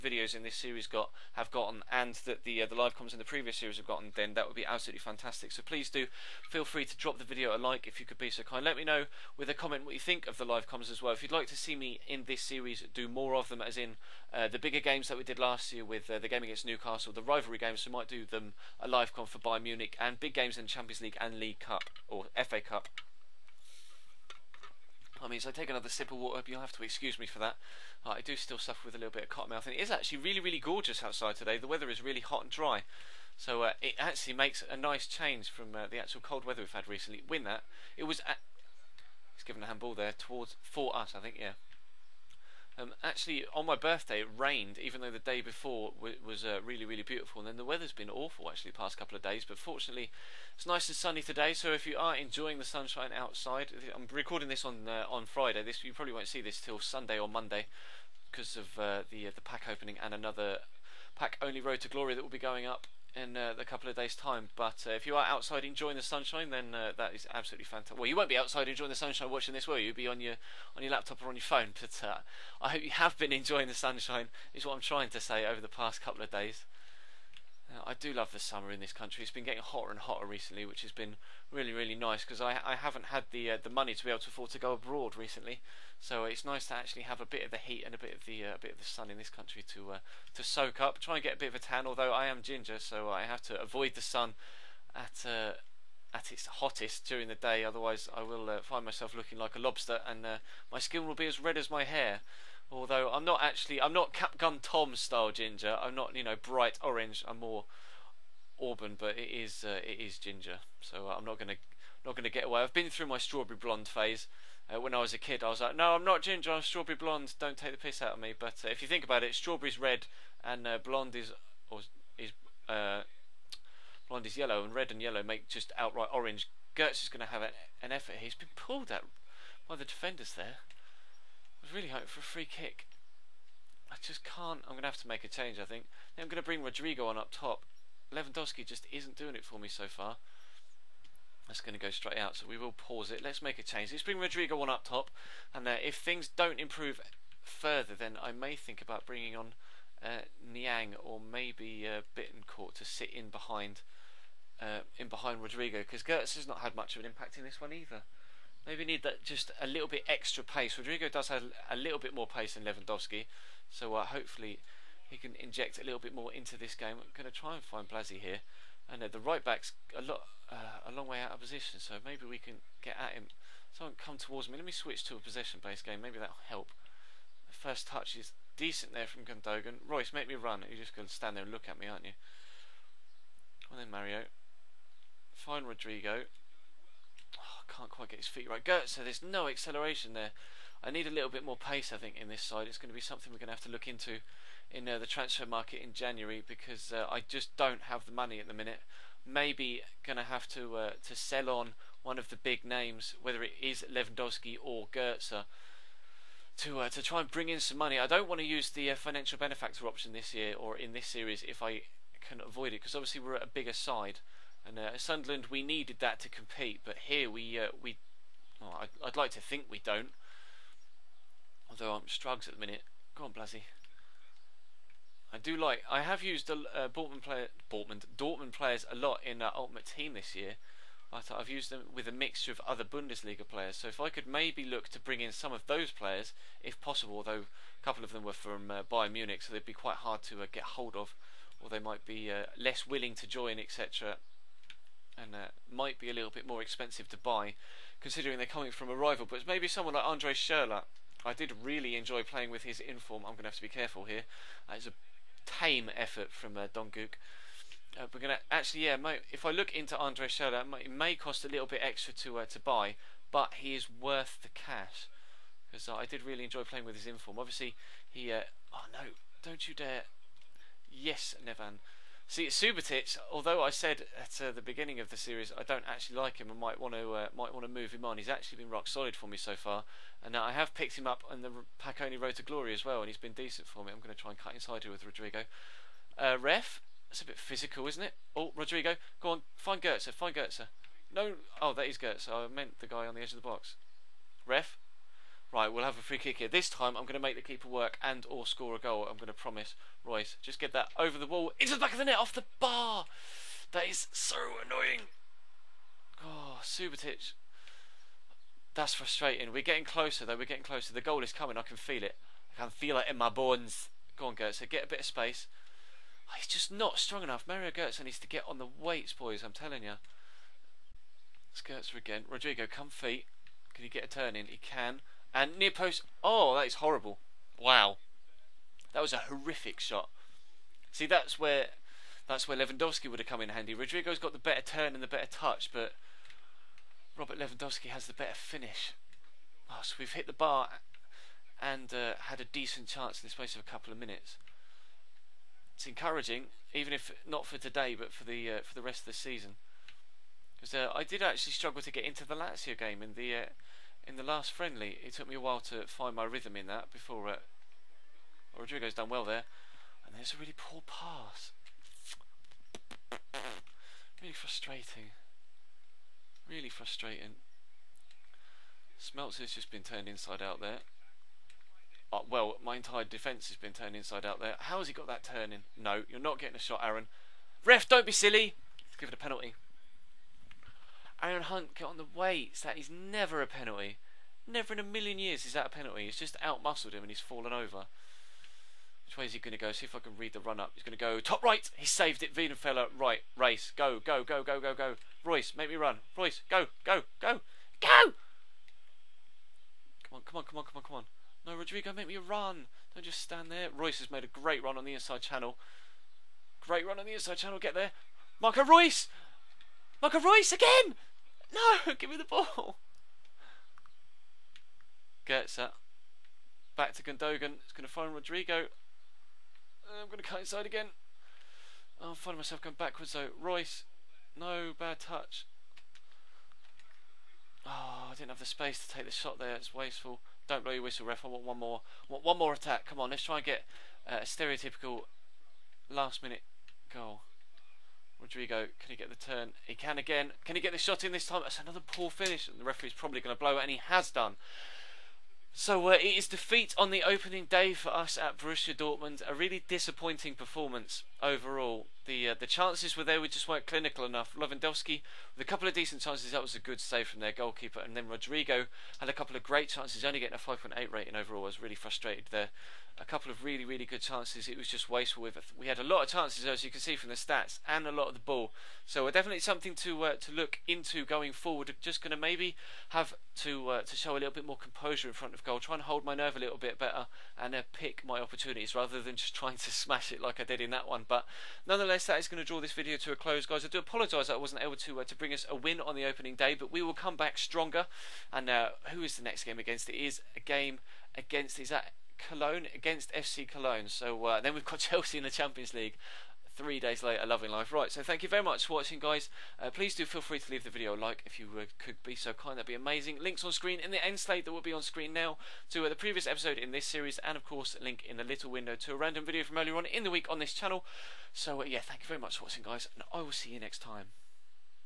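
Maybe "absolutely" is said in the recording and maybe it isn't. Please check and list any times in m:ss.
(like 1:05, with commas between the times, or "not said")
0:04, 1:07.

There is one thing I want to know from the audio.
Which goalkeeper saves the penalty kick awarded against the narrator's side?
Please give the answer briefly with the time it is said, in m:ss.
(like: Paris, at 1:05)
Weidenfeller, at 6:32.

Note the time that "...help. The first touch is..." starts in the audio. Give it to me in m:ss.
2:56.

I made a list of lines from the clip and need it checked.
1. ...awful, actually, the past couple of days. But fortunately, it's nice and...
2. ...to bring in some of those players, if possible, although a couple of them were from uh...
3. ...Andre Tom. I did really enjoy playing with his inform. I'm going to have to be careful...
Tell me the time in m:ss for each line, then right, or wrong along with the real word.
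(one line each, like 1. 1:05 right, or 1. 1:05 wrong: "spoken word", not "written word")
1. 0:48 right
2. 3:54 right
3. 4:10 wrong: "Schürrle", not "Tom".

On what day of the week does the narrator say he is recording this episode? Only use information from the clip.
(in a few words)
Friday.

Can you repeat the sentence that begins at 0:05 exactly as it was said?
So please do feel free to drop the video a like if you could be so kind.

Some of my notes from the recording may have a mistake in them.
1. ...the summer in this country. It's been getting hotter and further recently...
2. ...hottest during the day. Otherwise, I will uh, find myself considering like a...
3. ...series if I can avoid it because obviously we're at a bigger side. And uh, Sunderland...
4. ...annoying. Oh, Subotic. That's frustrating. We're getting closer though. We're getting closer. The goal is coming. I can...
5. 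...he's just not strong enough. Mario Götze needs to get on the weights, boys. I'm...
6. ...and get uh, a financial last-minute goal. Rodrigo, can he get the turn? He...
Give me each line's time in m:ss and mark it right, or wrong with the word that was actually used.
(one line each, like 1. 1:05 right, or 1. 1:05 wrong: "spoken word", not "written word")
1. 1:18 wrong: "hotter", not "further"
2. 1:36 wrong: "looking", not "considering"
3. 3:31 right
4. 5:04 right
5. 5:16 right
6. 7:13 wrong: "stereotypical", not "financial".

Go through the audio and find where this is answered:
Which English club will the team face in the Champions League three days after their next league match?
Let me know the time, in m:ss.
8:14.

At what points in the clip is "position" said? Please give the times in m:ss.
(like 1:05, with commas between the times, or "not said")
2:51.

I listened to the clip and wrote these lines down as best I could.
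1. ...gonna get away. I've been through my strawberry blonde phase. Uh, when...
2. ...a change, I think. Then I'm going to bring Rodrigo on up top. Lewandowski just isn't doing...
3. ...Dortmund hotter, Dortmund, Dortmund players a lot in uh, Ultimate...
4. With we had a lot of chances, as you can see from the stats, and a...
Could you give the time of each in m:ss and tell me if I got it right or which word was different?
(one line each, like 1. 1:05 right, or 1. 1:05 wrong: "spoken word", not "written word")
1. 1:52 right
2. 2:15 right
3. 3:46 wrong: "player", not "hotter"
4. 7:45 right.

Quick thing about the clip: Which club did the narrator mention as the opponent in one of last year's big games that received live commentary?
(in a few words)
Newcastle.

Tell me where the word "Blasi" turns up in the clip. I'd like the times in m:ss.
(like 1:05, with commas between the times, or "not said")
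2:47, 3:43.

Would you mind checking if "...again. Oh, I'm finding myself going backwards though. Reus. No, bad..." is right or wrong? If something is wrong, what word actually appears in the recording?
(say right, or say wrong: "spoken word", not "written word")
right.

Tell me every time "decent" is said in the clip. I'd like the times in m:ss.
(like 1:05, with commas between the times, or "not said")
2:58, 4:43, 5:42, 7:35.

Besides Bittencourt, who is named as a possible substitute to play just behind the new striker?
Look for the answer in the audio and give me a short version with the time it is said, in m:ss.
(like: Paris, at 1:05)
Niang, at 2:30.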